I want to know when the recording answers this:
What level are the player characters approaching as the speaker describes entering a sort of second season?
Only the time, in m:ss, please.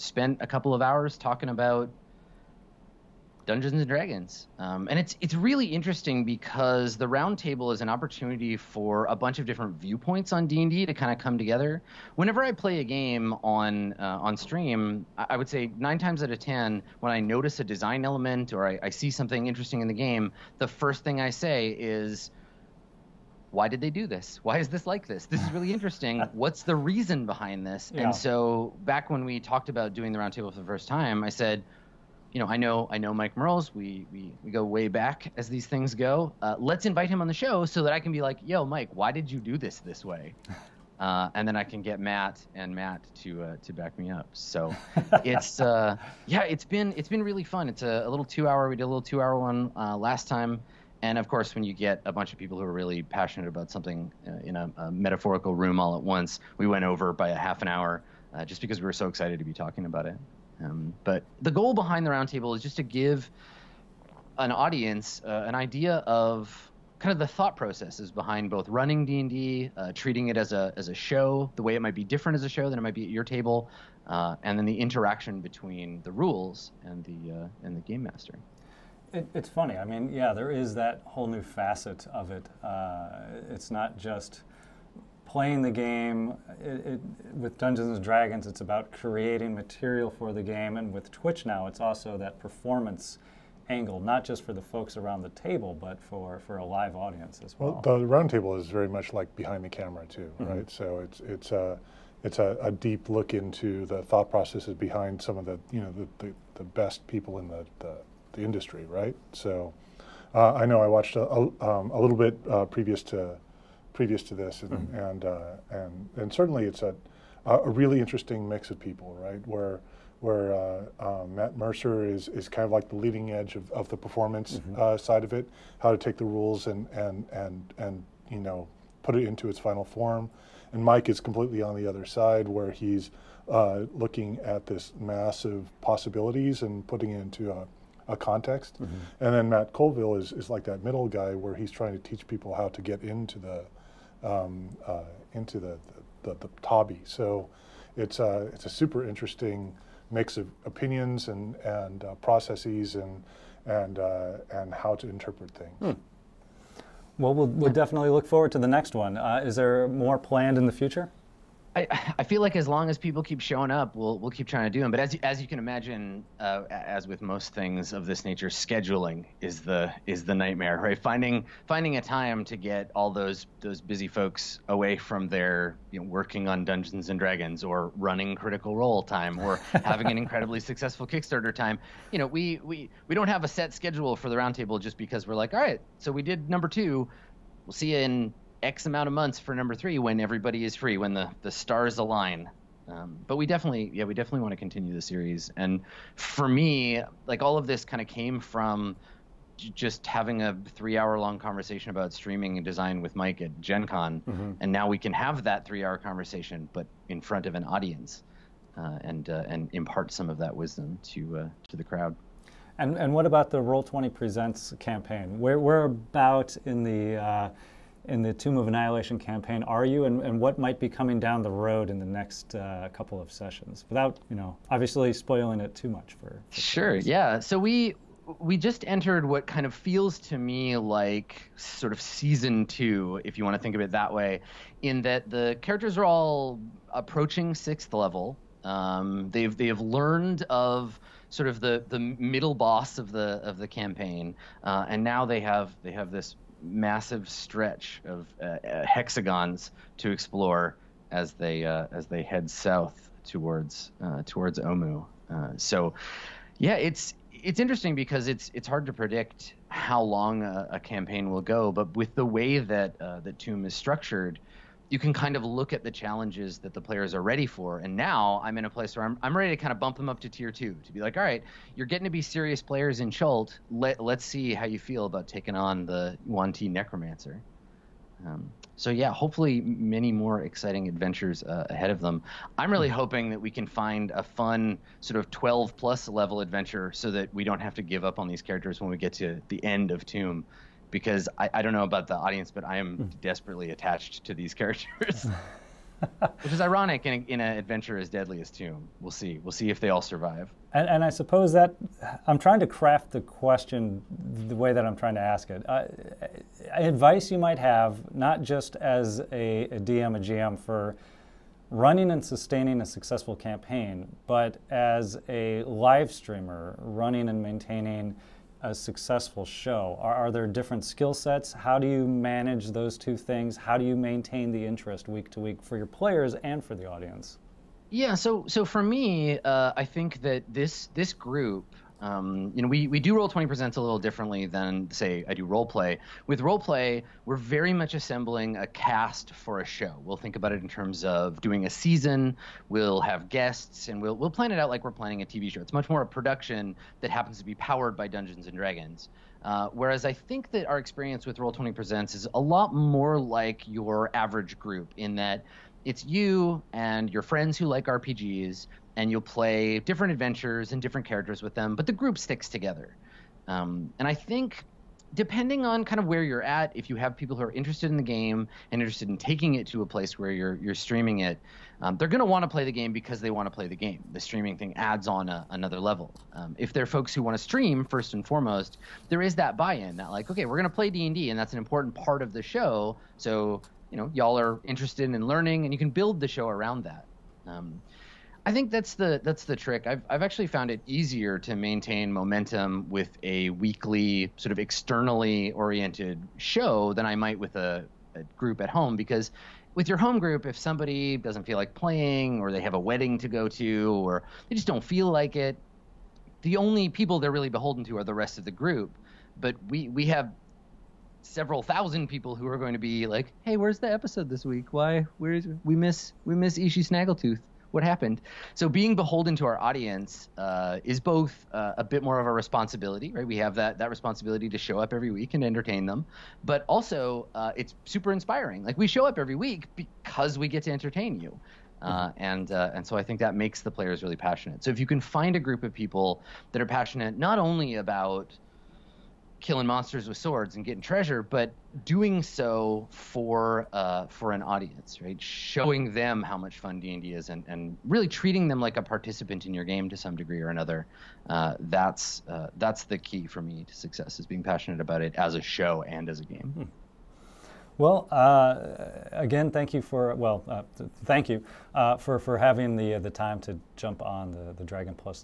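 3:57.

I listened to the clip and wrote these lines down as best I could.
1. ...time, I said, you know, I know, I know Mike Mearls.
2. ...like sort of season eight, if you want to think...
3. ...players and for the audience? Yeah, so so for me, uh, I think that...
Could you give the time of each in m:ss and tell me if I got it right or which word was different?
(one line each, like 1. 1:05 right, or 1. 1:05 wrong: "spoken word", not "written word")
1. 0:30 right
2. 3:50 wrong: "two", not "eight"
3. 5:25 right.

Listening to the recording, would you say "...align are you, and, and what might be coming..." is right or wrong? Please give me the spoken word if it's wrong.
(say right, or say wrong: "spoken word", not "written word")
wrong: "campaign", not "align".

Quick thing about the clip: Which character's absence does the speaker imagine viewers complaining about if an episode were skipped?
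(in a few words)
Ishi Snaggletooth.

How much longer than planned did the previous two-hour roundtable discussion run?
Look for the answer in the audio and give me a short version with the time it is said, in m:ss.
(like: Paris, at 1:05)
Half an hour, at 0:57.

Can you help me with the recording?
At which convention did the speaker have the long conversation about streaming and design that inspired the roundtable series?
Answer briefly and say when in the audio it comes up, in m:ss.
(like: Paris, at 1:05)
Gen Con, at 3:23.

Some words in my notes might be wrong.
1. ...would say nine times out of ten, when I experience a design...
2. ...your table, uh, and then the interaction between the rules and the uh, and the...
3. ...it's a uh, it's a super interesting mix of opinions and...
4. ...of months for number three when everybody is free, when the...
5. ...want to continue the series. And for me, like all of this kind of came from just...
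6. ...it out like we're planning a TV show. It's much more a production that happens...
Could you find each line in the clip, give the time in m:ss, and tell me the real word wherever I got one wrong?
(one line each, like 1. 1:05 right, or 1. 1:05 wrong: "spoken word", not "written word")
1. 0:15 wrong: "notice", not "experience"
2. 1:13 right
3. 2:27 right
4. 3:09 right
5. 3:14 right
6. 5:44 right.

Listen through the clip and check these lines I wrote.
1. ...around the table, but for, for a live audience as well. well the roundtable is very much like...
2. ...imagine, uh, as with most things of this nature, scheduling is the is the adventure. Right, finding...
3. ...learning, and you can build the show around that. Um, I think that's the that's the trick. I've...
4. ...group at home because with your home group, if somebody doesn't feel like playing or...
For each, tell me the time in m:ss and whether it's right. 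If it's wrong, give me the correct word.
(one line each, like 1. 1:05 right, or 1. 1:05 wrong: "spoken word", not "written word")
1. 1:34 right
2. 2:45 wrong: "nightmare", not "adventure"
3. 6:25 right
4. 6:38 right.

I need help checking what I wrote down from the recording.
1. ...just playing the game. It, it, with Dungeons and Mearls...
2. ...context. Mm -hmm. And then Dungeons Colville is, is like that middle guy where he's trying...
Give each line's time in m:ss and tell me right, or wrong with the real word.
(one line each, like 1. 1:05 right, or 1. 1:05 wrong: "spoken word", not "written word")
1. 1:23 wrong: "Dragons", not "Mearls"
2. 2:18 wrong: "Matt", not "Dungeons".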